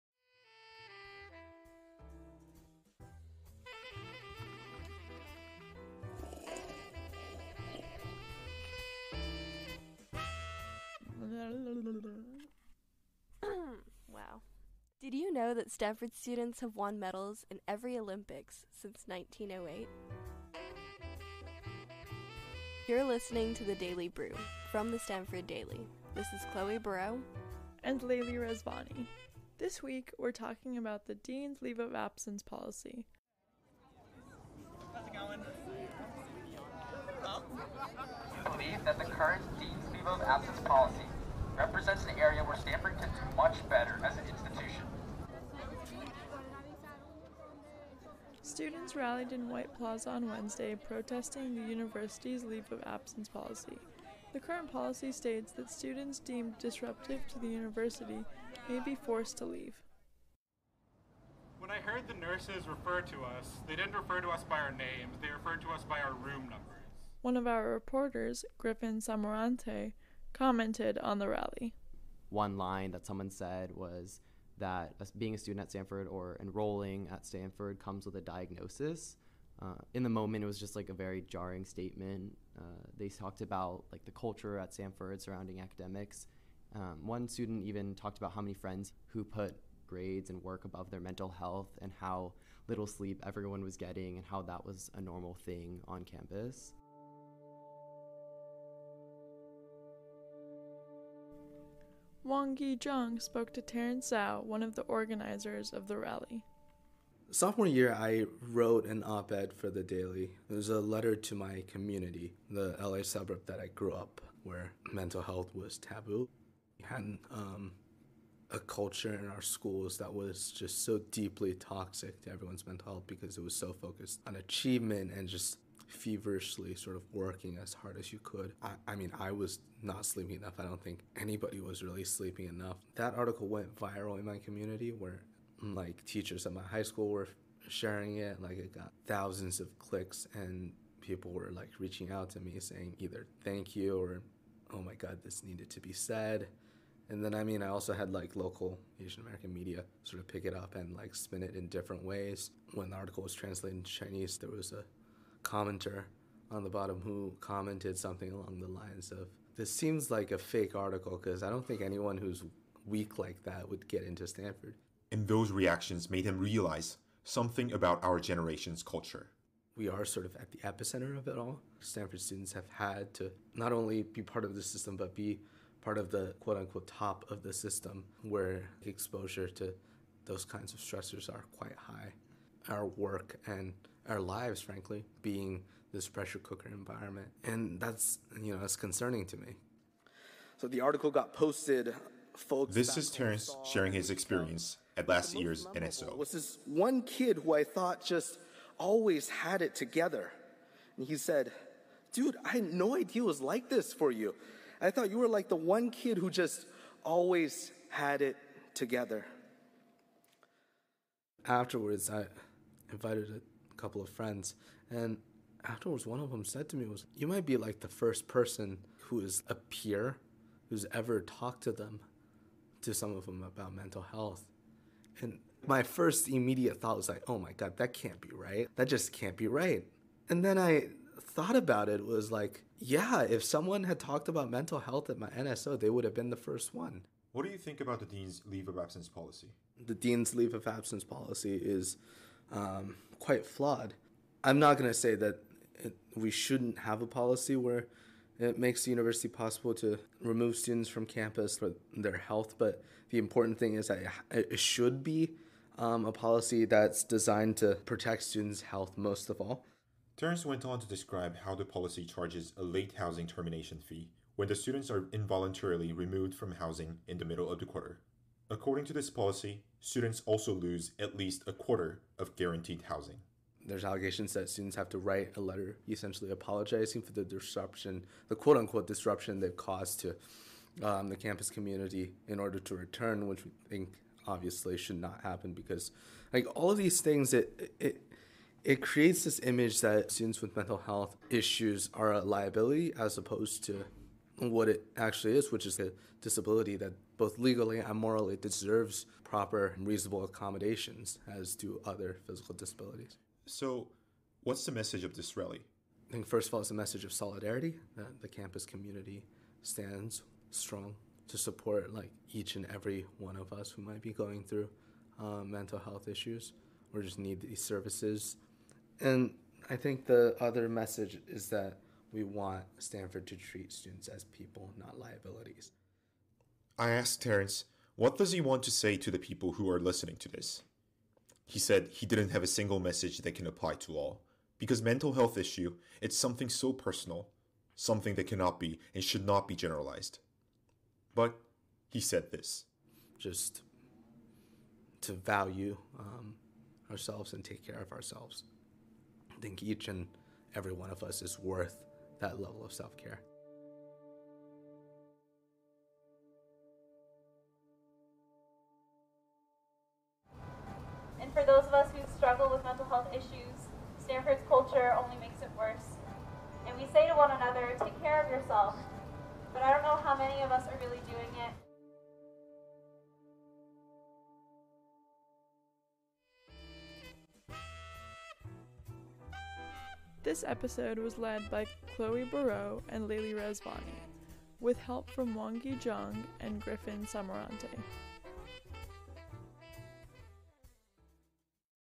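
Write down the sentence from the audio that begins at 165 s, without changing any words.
And those reactions made him realize something about our generation's culture.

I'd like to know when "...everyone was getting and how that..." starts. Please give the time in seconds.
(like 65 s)
93 s.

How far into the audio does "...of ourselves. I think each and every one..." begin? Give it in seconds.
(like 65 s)
347 s.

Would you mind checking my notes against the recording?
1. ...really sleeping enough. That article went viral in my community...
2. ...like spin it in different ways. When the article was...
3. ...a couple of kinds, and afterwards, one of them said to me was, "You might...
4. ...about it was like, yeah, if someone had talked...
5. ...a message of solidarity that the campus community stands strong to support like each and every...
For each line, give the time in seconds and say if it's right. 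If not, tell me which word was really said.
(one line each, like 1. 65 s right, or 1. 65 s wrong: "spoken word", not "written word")
1. 131 s right
2. 150 s right
3. 213 s wrong: "friends", not "kinds"
4. 231 s right
5. 306 s right.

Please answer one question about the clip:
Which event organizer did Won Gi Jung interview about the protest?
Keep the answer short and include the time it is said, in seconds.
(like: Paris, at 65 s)
Terrence Zhao, at 103 s.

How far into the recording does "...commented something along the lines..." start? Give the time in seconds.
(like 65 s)
157 s.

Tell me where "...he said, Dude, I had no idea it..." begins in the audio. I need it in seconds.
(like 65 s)
201 s.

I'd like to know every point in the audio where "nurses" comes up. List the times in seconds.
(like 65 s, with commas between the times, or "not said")
62 s.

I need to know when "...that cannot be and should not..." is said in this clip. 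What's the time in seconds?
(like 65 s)
338 s.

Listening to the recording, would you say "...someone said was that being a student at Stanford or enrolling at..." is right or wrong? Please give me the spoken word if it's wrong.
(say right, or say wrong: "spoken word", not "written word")
right.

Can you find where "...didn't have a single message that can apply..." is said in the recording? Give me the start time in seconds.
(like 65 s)
332 s.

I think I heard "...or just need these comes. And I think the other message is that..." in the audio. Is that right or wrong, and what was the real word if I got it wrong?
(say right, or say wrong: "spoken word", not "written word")
wrong: "services", not "comes".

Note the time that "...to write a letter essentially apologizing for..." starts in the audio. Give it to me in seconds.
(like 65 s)
274 s.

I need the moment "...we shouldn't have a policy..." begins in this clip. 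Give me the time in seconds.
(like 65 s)
246 s.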